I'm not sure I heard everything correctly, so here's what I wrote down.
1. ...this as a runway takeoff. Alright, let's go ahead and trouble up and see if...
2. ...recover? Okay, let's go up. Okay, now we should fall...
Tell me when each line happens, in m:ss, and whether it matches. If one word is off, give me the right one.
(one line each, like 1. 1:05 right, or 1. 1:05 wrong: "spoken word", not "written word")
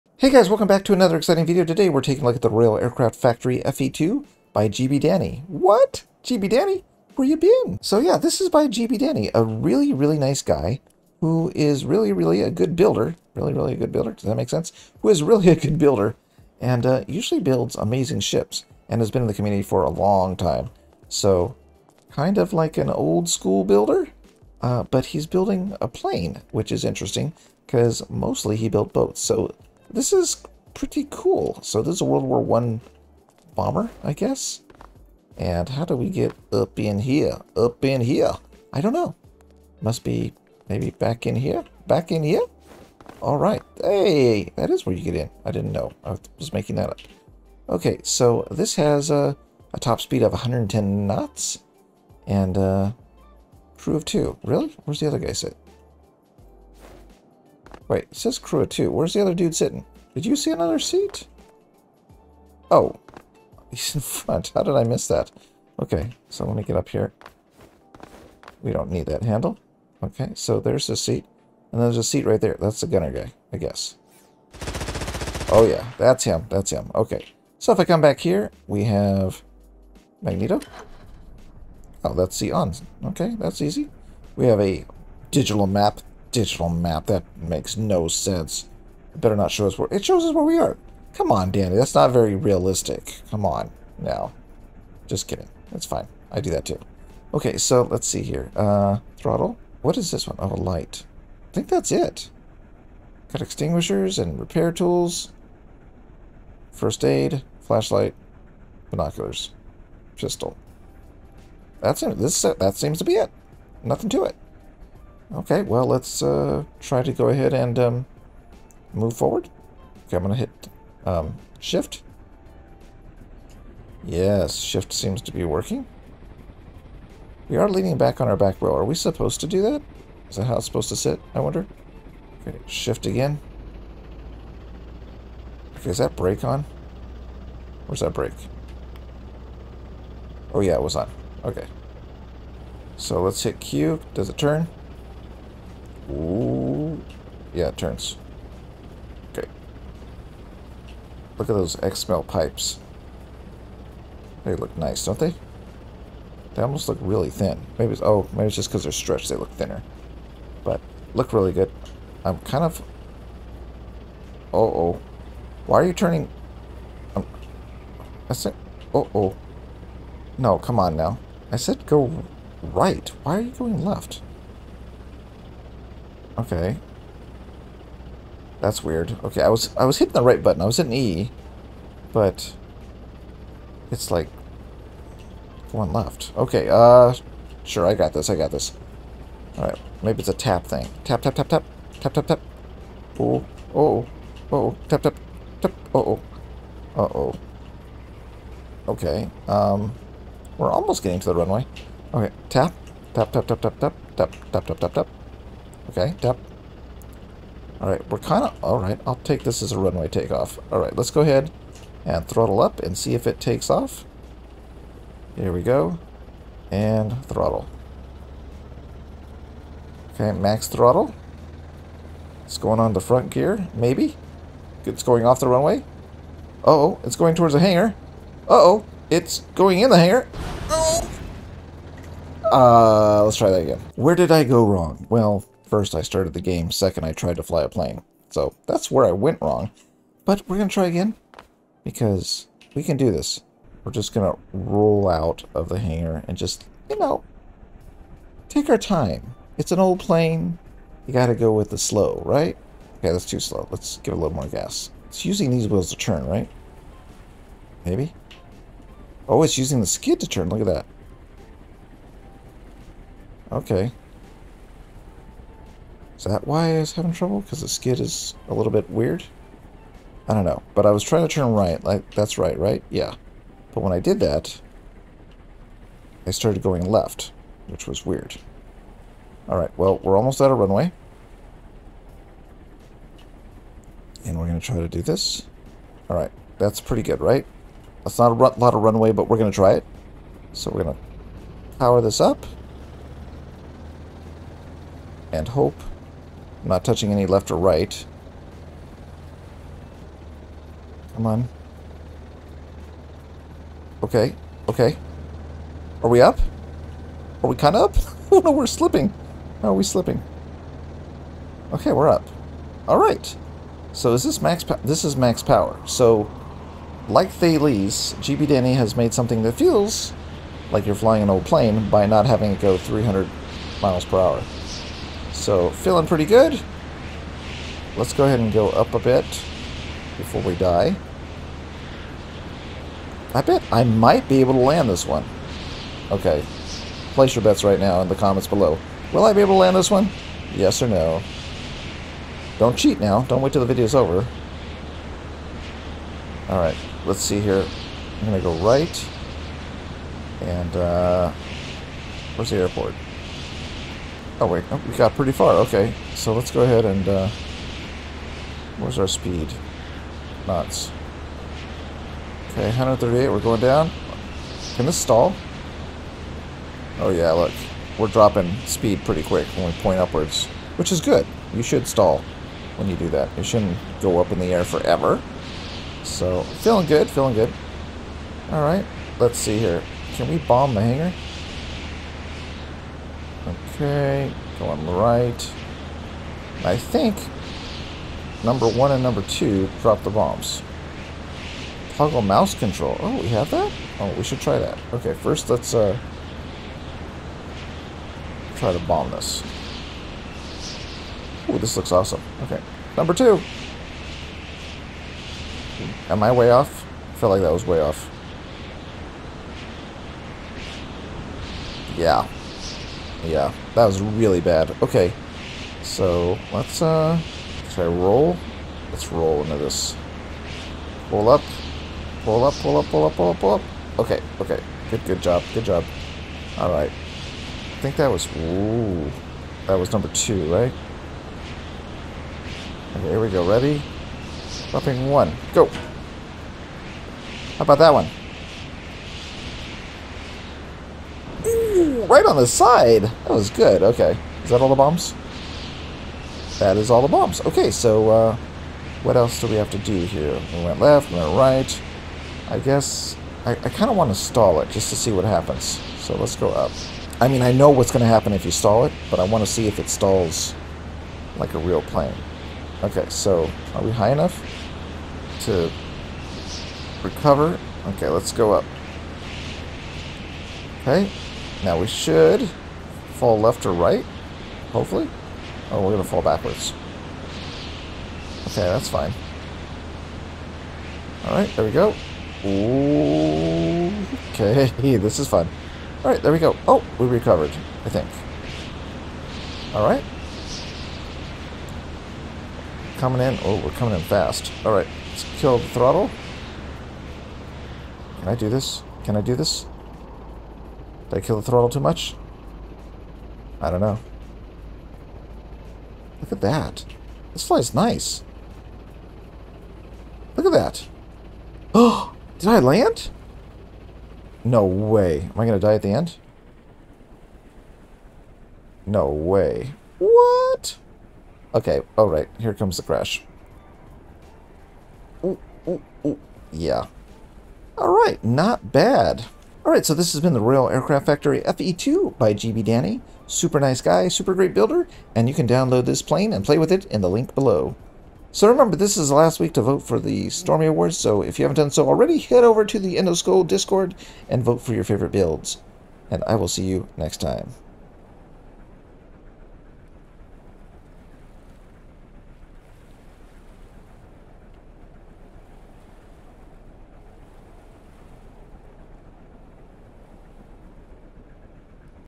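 1. 3:29 wrong: "throttle", not "trouble"
2. 7:47 right.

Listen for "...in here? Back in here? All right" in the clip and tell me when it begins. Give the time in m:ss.
0:41.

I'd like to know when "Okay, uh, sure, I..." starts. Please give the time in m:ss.
3:06.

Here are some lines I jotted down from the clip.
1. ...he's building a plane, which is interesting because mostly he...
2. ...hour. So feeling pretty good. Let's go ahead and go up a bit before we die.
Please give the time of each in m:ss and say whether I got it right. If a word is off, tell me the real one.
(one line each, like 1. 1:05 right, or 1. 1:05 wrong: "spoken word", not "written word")
1. 0:25 right
2. 5:24 right.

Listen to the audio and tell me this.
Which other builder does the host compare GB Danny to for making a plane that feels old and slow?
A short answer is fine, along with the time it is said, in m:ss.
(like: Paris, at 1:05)
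Thales, at 5:17.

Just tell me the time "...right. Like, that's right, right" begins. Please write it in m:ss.
4:31.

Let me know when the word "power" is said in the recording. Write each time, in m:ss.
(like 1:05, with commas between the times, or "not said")
4:51, 5:15.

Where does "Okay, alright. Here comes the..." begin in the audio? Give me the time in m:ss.
8:41.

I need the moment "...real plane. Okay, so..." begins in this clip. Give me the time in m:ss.
7:41.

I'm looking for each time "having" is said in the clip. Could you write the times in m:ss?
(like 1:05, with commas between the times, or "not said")
4:26, 5:22.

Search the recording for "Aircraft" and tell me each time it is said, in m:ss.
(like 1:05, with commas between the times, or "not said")
0:02, 8:50.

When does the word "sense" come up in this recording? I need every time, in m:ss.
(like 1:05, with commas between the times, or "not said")
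0:14, 1:28.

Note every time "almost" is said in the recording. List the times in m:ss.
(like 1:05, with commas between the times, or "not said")
2:36, 3:20, 4:40.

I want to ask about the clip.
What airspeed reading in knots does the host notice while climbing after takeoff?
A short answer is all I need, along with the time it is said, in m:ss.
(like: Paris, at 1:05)
138, at 6:02.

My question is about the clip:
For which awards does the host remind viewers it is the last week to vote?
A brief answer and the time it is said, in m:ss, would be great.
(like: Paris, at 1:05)
Stormy Awards, at 9:00.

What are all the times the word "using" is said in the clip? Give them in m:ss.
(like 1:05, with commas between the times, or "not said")
4:15, 4:19.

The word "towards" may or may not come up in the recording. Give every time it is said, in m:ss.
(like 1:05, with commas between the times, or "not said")
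3:47.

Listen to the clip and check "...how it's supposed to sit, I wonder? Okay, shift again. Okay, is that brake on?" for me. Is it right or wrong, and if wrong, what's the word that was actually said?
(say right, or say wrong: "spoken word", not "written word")
right.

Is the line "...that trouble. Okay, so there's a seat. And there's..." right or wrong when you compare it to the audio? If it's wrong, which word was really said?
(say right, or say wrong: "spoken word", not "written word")
wrong: "handle", not "trouble".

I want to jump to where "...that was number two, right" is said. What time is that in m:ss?
7:09.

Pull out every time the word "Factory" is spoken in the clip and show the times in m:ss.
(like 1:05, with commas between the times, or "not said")
0:03, 8:51.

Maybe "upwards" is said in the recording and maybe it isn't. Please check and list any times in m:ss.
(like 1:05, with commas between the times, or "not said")
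6:09.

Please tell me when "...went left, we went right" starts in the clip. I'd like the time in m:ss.
7:30.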